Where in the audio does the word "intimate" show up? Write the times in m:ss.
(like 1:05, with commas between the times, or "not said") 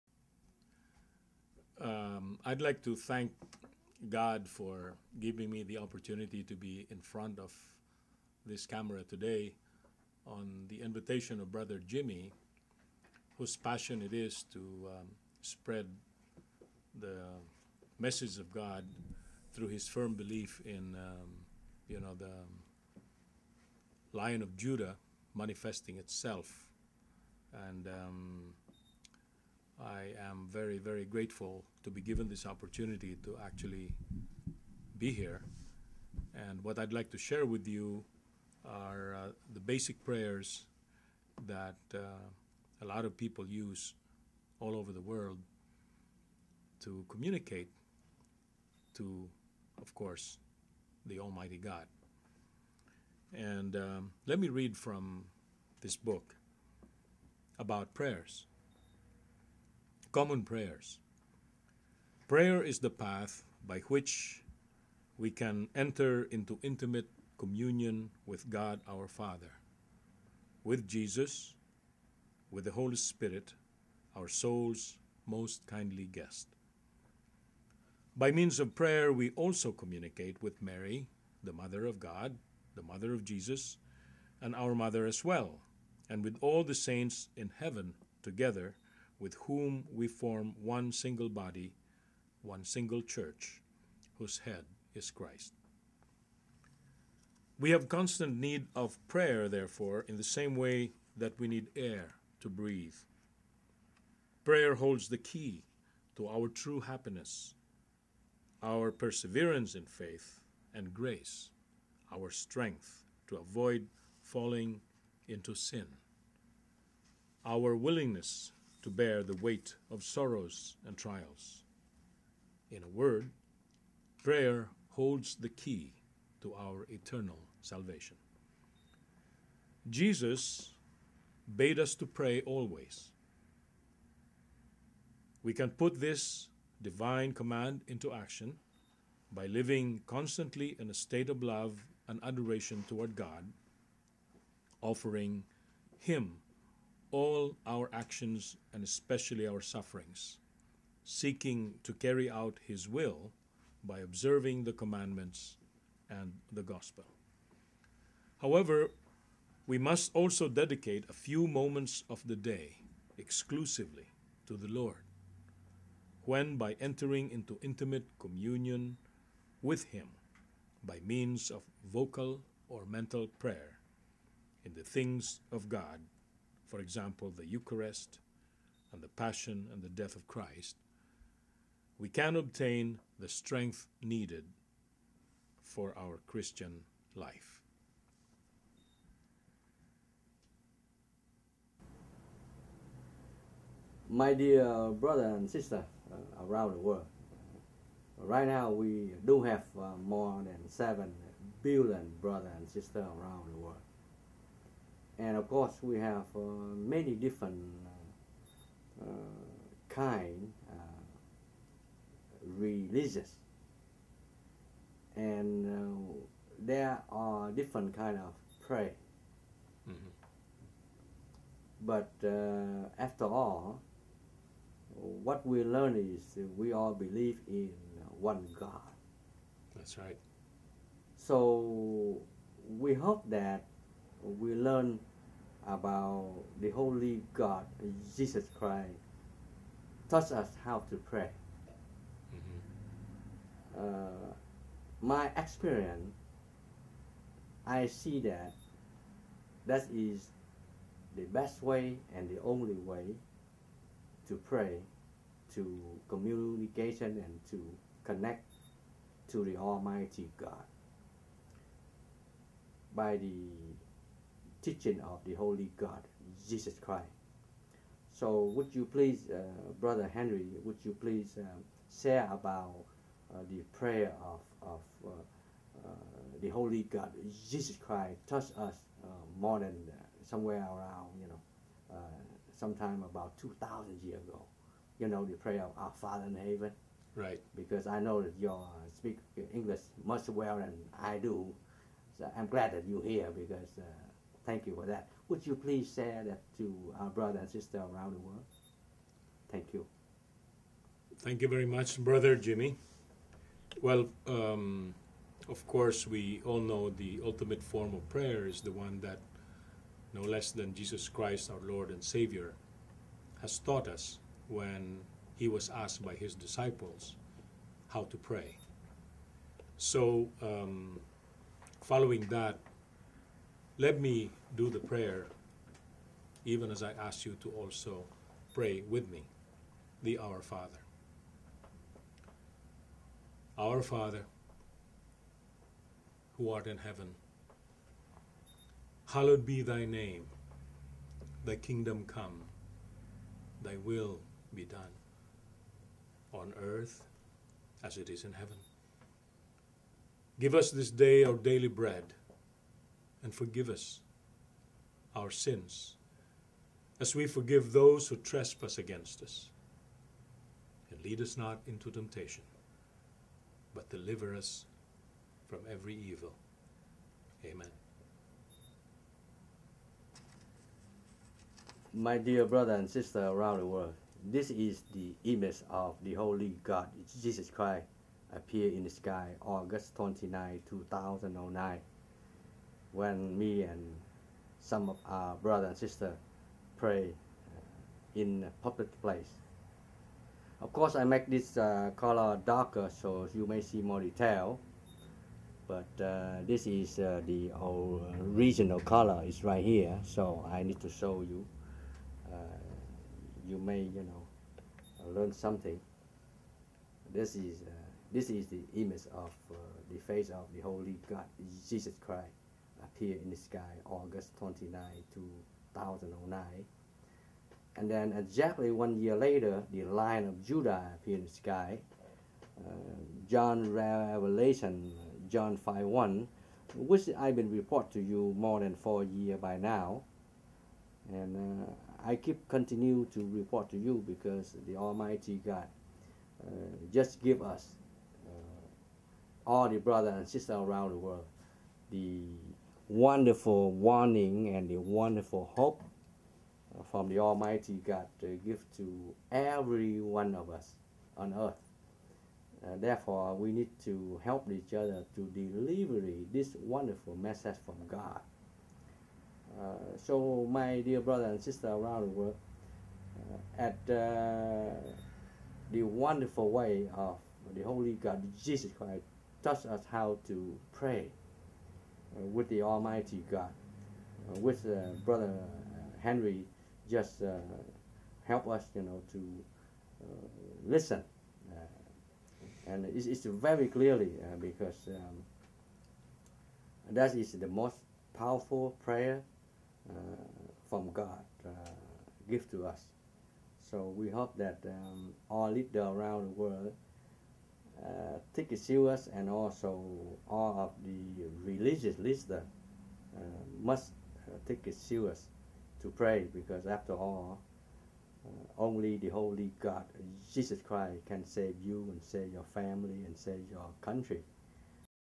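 1:06, 2:47.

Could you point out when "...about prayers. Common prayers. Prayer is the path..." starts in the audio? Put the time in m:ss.
0:57.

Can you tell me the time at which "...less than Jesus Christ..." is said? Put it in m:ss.
5:10.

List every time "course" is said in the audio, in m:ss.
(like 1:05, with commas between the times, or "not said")
0:49, 3:25, 5:05, 6:30.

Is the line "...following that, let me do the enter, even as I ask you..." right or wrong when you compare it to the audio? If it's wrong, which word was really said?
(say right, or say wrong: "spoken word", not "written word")
wrong: "prayer", not "enter".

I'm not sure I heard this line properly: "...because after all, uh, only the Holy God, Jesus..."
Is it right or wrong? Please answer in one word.
right.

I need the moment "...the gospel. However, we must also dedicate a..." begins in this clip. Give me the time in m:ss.
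2:36.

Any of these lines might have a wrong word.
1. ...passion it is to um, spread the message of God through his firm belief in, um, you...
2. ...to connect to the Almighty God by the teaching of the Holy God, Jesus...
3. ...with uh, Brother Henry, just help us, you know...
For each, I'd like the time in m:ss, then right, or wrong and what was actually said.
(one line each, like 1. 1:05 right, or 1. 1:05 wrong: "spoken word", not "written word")
1. 0:13 right
2. 4:17 right
3. 7:54 right.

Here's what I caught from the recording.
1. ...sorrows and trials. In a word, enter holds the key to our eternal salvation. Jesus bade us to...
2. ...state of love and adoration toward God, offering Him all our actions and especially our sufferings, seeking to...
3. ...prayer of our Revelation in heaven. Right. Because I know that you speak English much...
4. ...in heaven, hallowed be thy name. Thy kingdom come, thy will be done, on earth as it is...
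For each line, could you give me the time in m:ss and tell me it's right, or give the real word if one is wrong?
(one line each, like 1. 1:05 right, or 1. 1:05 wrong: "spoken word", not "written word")
1. 2:00 wrong: "prayer", not "enter"
2. 2:20 right
3. 4:45 wrong: "Father", not "Revelation"
4. 5:36 right.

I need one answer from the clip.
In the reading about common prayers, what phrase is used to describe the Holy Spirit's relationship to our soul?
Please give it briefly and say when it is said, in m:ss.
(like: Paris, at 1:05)
our soul's most kindly guest, at 1:14.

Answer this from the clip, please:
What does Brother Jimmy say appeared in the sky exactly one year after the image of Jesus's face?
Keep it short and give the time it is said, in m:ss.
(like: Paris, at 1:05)
the Lion of Judah, at 6:59.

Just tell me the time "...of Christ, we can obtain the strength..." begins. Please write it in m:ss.
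3:00.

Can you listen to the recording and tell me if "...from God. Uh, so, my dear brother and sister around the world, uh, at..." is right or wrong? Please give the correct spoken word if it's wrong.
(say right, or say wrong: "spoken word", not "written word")
right.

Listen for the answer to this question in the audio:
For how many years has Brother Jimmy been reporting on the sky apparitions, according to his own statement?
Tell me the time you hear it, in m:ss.
7:08.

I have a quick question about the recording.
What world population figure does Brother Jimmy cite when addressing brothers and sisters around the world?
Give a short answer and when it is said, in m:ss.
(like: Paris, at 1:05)
more than 7 billion, at 3:20.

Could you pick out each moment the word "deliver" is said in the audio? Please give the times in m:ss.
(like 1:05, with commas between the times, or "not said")
6:03, 7:35.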